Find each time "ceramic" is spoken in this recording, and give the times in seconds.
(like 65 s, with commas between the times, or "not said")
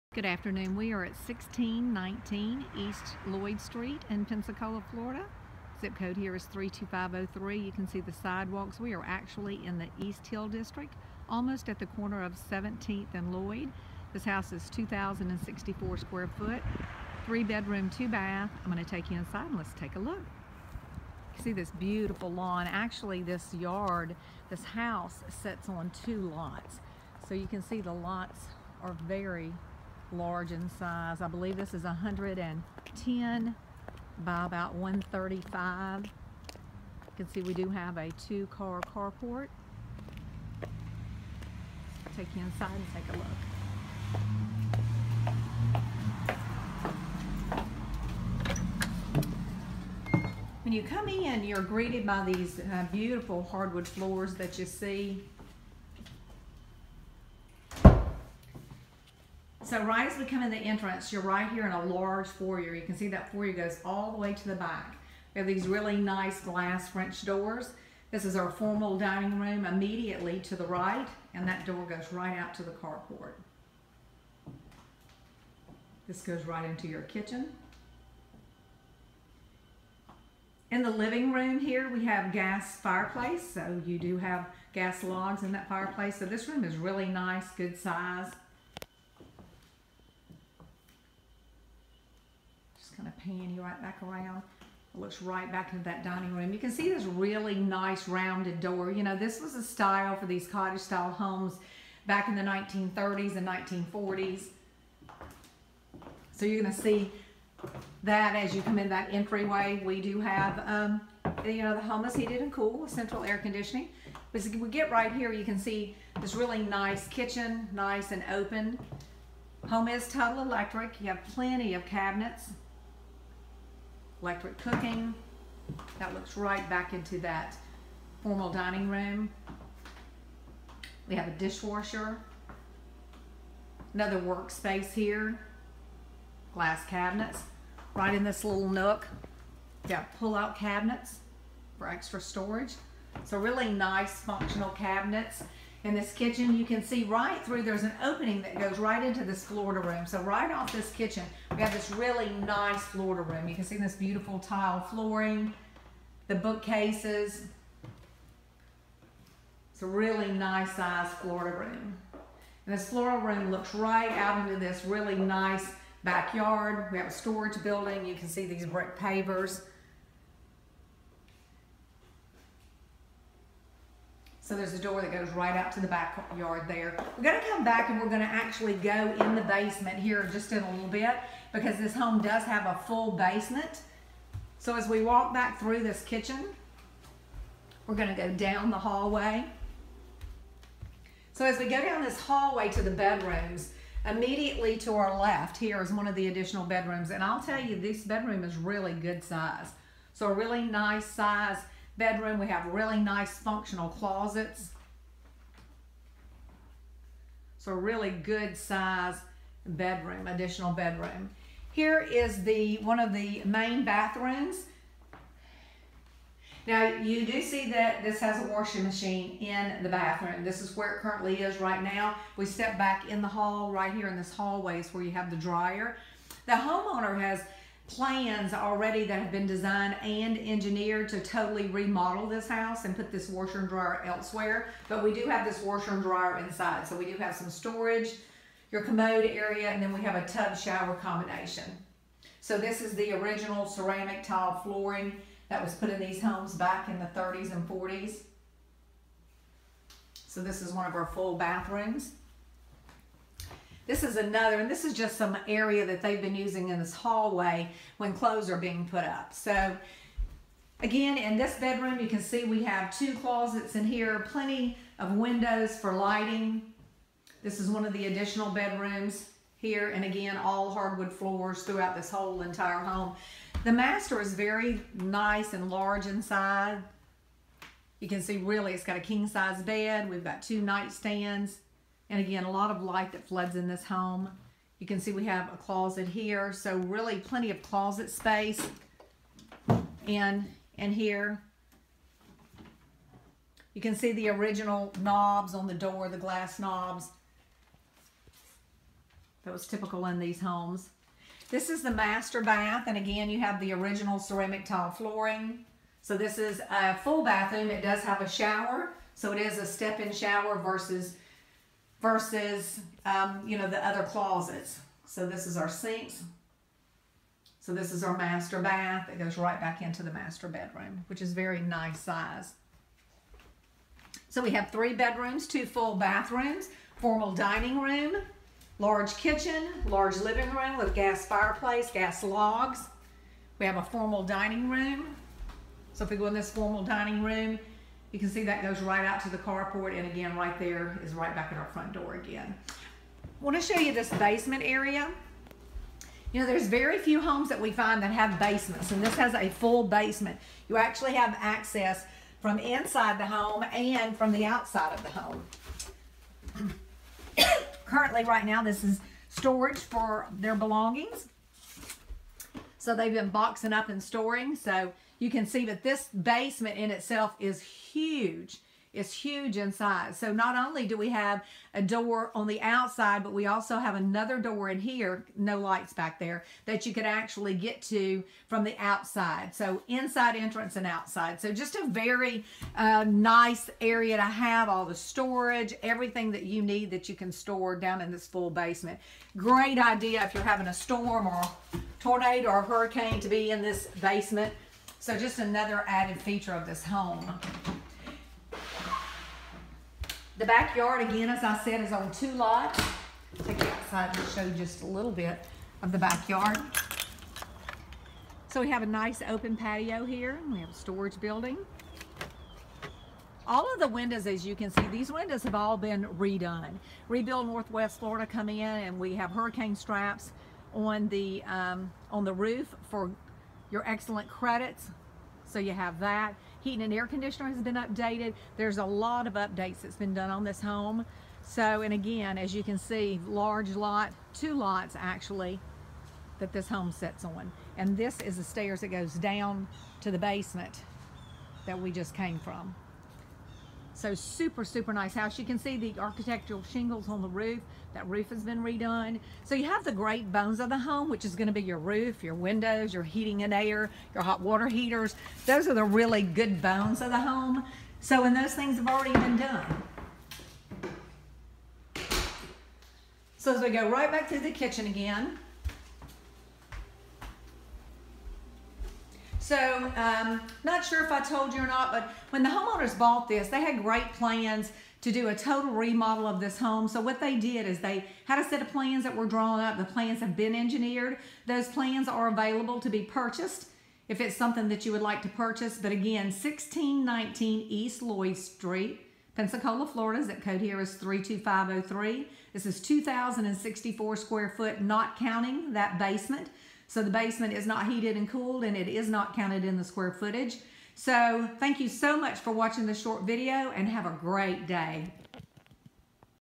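243 s, 304 s.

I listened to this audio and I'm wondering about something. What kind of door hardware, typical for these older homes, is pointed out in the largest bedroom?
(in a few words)
glass knobs.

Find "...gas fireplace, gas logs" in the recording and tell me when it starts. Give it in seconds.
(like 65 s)
330 s.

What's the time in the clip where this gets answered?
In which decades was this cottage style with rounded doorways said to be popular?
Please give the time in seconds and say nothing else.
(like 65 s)
102 s.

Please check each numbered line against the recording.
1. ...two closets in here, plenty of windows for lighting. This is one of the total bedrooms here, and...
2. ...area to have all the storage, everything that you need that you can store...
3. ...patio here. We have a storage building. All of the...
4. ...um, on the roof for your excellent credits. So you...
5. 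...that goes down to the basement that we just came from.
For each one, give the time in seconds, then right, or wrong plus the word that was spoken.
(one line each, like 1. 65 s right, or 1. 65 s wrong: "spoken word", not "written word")
1. 262 s wrong: "additional", not "total"
2. 383 s right
3. 409 s right
4. 421 s right
5. 438 s right.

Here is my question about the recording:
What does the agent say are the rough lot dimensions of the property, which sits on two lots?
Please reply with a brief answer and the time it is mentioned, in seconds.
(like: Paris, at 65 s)
110 by 135, at 31 s.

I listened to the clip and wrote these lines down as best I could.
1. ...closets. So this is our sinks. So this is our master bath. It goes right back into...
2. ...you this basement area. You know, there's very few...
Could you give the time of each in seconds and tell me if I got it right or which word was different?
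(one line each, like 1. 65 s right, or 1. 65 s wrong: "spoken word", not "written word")
1. 314 s right
2. 343 s right.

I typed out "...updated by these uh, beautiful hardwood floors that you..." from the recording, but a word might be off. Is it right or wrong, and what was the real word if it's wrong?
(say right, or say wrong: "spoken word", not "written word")
wrong: "greeted", not "updated".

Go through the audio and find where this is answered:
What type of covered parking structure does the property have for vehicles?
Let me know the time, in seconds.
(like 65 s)
38 s.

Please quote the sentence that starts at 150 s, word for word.
So right off this kitchen, we have this really nice Florida room.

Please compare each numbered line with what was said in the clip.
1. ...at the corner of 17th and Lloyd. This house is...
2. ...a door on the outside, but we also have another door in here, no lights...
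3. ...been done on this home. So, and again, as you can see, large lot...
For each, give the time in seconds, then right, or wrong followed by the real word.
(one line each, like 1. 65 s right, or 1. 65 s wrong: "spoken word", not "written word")
1. 11 s right
2. 371 s right
3. 429 s right.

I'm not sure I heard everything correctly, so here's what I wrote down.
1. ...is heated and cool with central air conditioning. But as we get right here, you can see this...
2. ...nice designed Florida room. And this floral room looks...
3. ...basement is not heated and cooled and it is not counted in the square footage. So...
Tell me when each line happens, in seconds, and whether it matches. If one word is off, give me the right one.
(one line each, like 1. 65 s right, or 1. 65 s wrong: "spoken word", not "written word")
1. 112 s right
2. 160 s wrong: "sized", not "designed"
3. 497 s right.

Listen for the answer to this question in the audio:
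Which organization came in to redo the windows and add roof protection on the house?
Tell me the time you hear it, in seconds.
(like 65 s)
417 s.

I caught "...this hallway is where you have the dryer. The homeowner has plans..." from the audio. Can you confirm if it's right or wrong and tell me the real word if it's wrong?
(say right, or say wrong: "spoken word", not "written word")
right.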